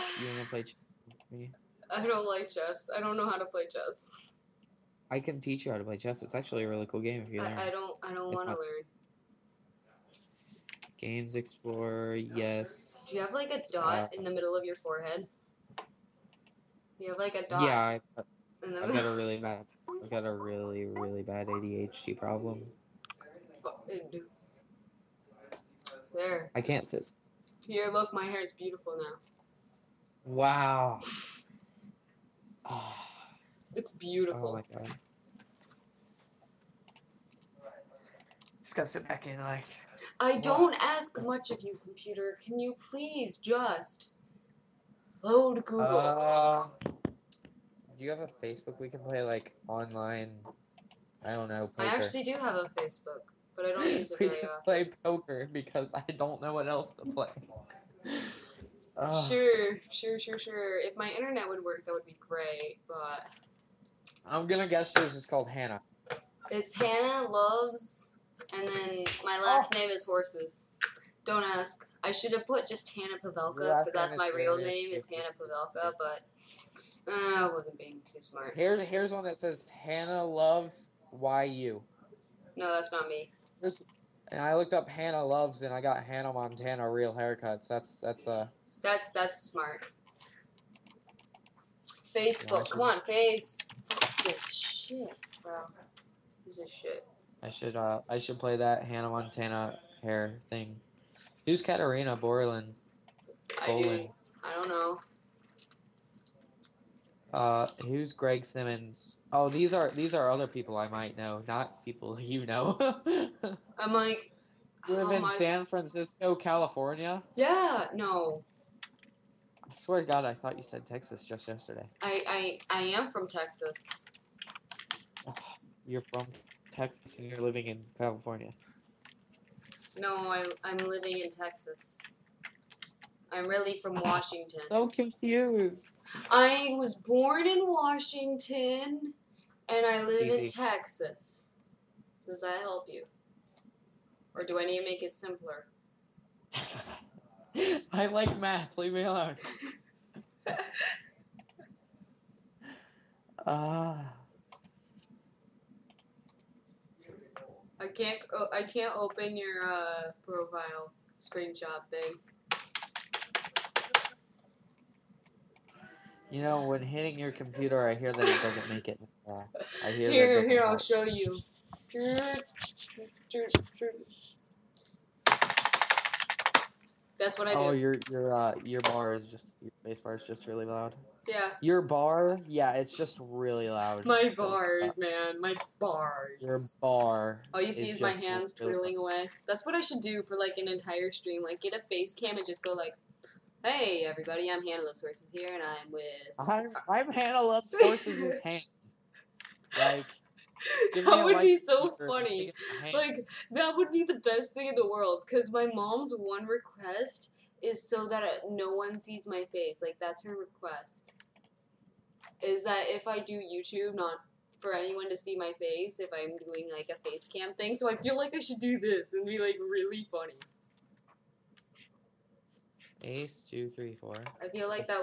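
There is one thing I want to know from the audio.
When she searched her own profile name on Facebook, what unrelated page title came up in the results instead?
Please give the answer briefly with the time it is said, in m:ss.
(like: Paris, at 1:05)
Hannah Montana Real Haircuts, at 1:26.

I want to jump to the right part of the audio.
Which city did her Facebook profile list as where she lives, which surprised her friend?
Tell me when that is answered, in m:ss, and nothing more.
1:55.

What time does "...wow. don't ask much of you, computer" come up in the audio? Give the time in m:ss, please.
0:40.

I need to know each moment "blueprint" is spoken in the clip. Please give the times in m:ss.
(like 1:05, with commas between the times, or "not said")
not said.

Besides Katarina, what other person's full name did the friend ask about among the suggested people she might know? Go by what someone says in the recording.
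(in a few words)
Greg Simmons.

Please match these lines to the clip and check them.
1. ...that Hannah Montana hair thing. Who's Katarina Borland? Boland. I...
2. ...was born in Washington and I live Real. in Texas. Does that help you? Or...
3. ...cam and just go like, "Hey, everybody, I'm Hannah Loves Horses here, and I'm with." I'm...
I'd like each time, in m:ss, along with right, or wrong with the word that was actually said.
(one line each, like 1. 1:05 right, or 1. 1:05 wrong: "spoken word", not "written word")
1. 1:38 right
2. 2:16 wrong: "Easy", not "Real"
3. 3:12 right.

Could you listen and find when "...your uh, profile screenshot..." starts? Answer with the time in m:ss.
2:39.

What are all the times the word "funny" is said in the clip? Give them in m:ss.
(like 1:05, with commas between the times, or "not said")
3:22, 3:40.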